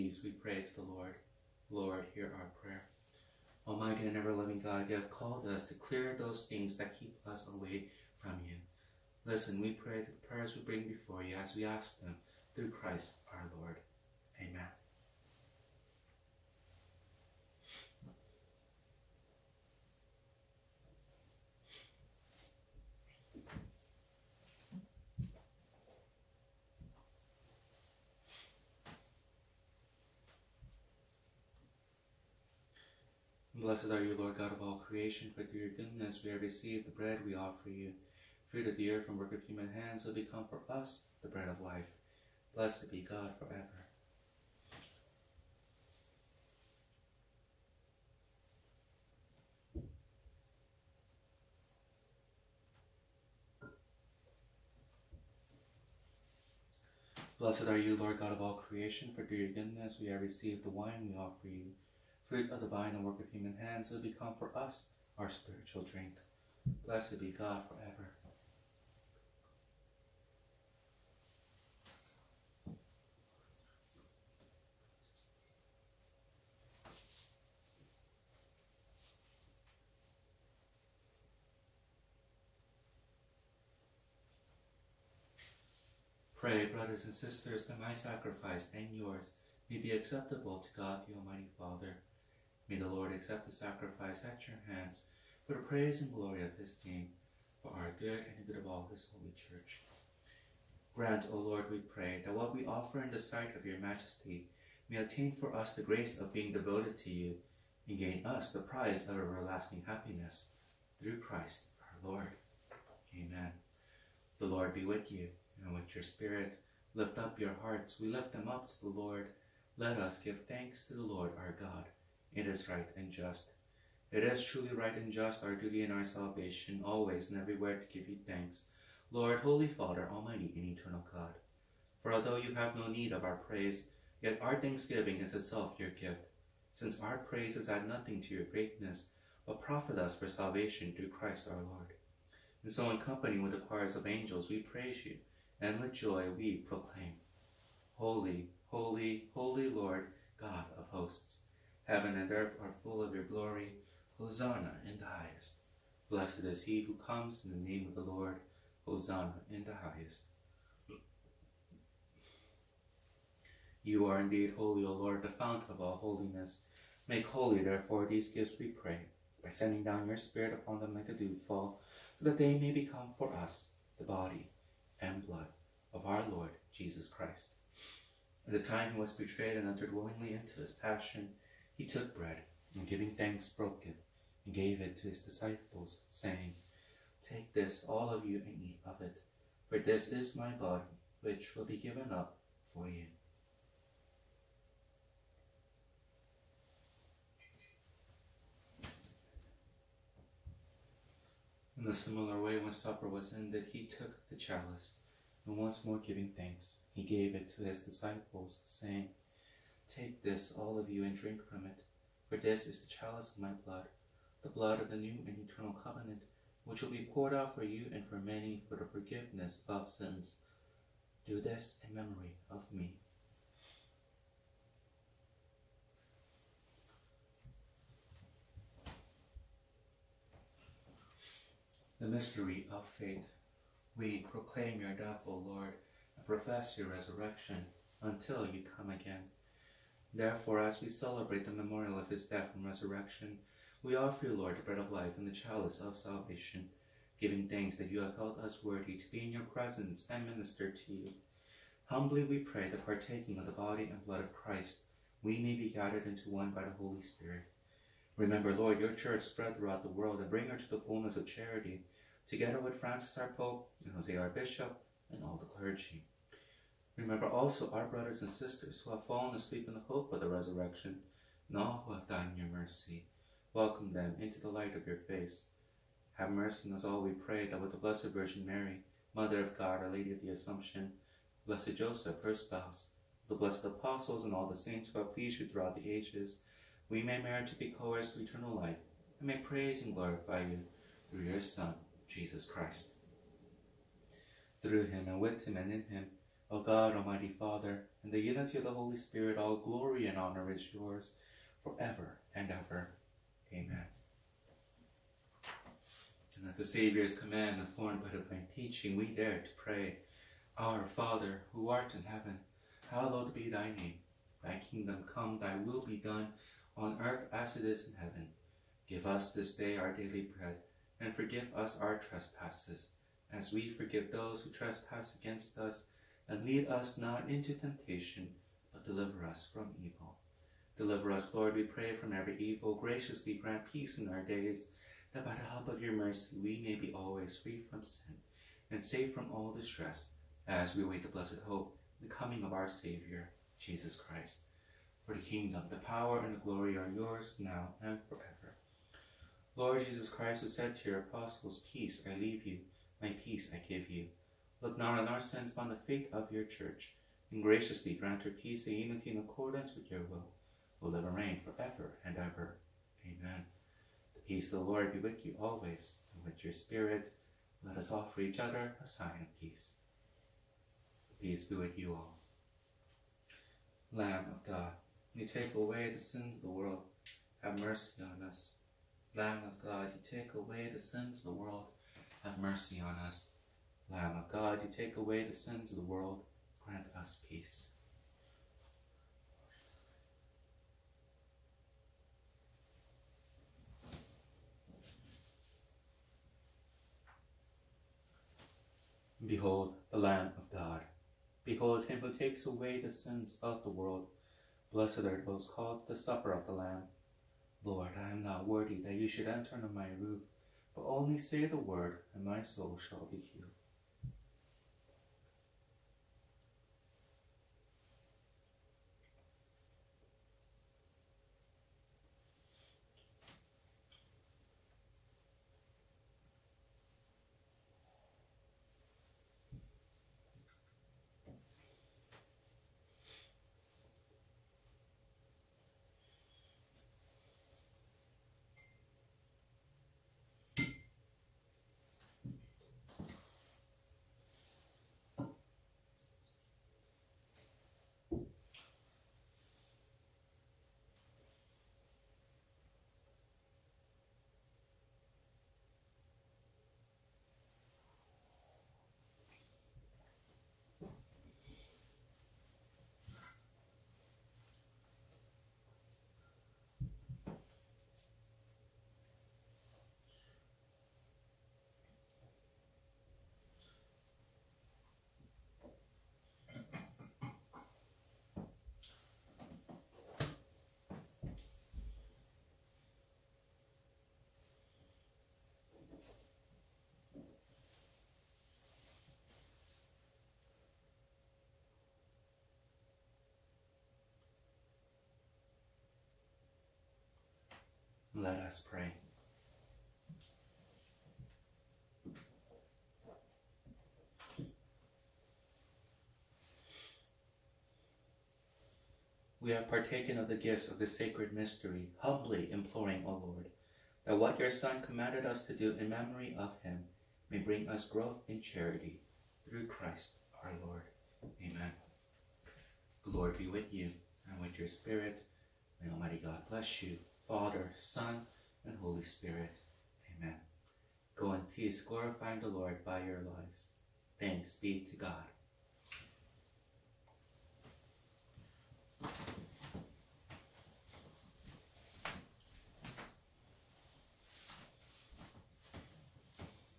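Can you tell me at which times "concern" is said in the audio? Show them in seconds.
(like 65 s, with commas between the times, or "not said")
not said.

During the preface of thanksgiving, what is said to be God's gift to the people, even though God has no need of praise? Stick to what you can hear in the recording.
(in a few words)
Our thanksgiving.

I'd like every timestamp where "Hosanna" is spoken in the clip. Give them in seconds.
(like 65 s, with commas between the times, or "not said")
154 s, 158 s.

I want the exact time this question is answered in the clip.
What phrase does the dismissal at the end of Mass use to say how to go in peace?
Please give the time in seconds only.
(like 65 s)
531 s.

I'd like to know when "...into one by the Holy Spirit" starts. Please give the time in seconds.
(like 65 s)
256 s.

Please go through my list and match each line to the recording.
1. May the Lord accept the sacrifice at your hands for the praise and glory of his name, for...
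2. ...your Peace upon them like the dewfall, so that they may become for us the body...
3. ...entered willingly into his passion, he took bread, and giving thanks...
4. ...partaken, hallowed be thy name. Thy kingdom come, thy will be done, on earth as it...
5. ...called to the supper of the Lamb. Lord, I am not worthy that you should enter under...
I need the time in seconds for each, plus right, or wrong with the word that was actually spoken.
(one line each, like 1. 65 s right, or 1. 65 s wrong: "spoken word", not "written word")
1. 92 s right
2. 170 s wrong: "Spirit", not "Peace"
3. 179 s right
4. 312 s wrong: "heaven", not "partaken"
5. 405 s right.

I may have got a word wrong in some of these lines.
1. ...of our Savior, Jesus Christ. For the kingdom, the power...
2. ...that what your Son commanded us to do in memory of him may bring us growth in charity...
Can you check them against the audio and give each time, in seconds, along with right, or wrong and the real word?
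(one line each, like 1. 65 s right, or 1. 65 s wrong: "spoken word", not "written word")
1. 342 s right
2. 514 s right.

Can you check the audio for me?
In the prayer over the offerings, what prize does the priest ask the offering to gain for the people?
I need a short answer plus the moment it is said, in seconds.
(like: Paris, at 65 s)
Everlasting happiness, at 109 s.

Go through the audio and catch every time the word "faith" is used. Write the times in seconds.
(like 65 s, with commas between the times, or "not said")
232 s, 355 s.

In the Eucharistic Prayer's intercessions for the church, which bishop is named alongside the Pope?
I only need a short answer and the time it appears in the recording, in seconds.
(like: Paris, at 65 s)
Jose, at 263 s.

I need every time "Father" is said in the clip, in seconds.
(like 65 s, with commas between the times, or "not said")
91 s, 129 s, 297 s, 310 s, 527 s.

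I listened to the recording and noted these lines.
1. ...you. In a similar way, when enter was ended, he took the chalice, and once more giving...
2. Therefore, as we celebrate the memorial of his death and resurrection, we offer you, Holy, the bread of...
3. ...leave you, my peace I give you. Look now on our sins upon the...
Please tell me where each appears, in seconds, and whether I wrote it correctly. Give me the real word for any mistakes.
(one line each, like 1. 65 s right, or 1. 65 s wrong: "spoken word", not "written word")
1. 192 s wrong: "supper", not "enter"
2. 240 s wrong: "Lord", not "Holy"
3. 352 s right.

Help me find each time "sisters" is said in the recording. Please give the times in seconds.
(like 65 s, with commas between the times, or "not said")
87 s, 268 s.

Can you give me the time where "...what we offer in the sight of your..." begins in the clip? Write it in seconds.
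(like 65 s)
102 s.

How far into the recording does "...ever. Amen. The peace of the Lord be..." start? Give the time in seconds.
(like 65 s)
362 s.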